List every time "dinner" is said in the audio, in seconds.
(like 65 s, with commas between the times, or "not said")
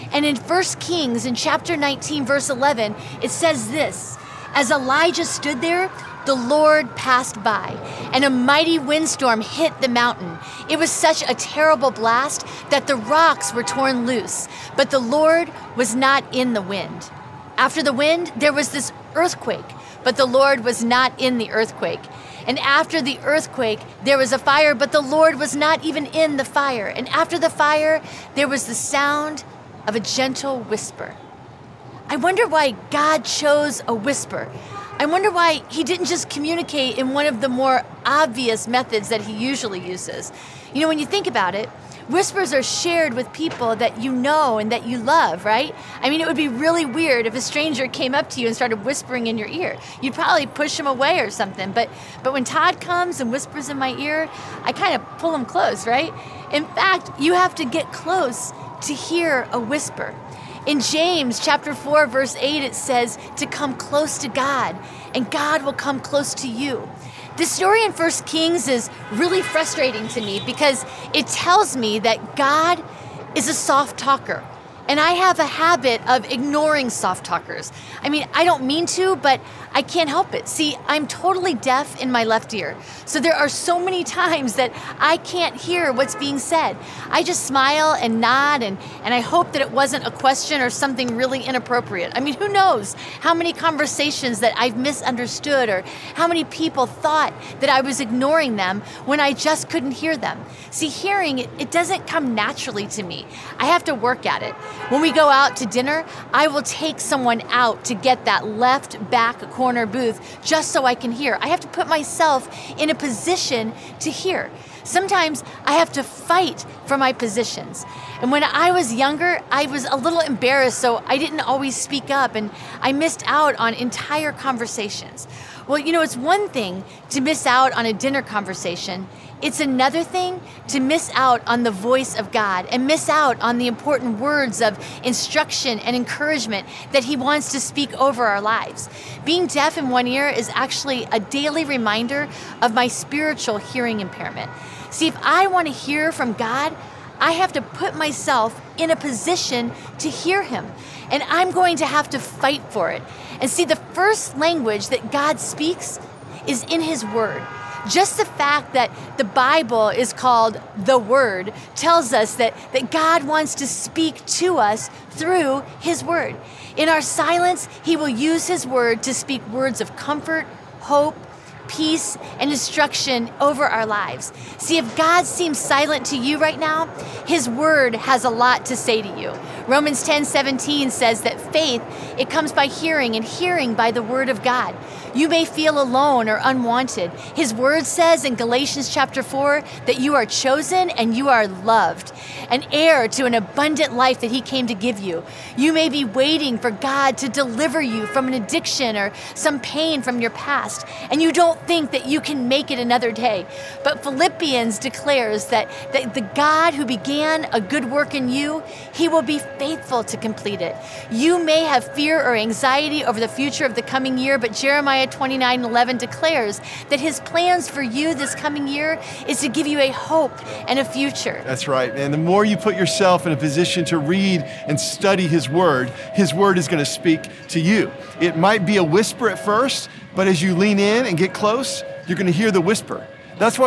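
105 s, 127 s.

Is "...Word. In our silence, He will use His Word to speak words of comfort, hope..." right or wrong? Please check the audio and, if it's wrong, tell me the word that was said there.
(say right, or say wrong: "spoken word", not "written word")
right.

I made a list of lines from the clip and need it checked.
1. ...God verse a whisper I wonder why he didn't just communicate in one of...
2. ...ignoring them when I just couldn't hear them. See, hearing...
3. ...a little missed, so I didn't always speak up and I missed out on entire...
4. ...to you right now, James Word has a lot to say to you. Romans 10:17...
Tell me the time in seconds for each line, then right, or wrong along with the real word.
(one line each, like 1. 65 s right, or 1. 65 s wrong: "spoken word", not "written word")
1. 32 s wrong: "chose", not "verse"
2. 98 s right
3. 119 s wrong: "embarrassed", not "missed"
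4. 176 s wrong: "His", not "James".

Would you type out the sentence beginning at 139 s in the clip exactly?
Being deaf in one ear is actually a daily reminder of my spiritual hearing impairment.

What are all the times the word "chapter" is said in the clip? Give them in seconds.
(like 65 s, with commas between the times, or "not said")
1 s, 61 s, 188 s.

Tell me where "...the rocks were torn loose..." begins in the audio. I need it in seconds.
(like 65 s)
12 s.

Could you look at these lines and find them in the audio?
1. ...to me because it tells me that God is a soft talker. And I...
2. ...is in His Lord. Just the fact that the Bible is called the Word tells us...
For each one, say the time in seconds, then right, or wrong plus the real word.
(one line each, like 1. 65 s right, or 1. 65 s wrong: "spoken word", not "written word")
1. 70 s right
2. 156 s wrong: "Word", not "Lord".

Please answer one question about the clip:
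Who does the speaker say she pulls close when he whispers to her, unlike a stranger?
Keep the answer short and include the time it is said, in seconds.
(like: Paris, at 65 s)
Todd, at 52 s.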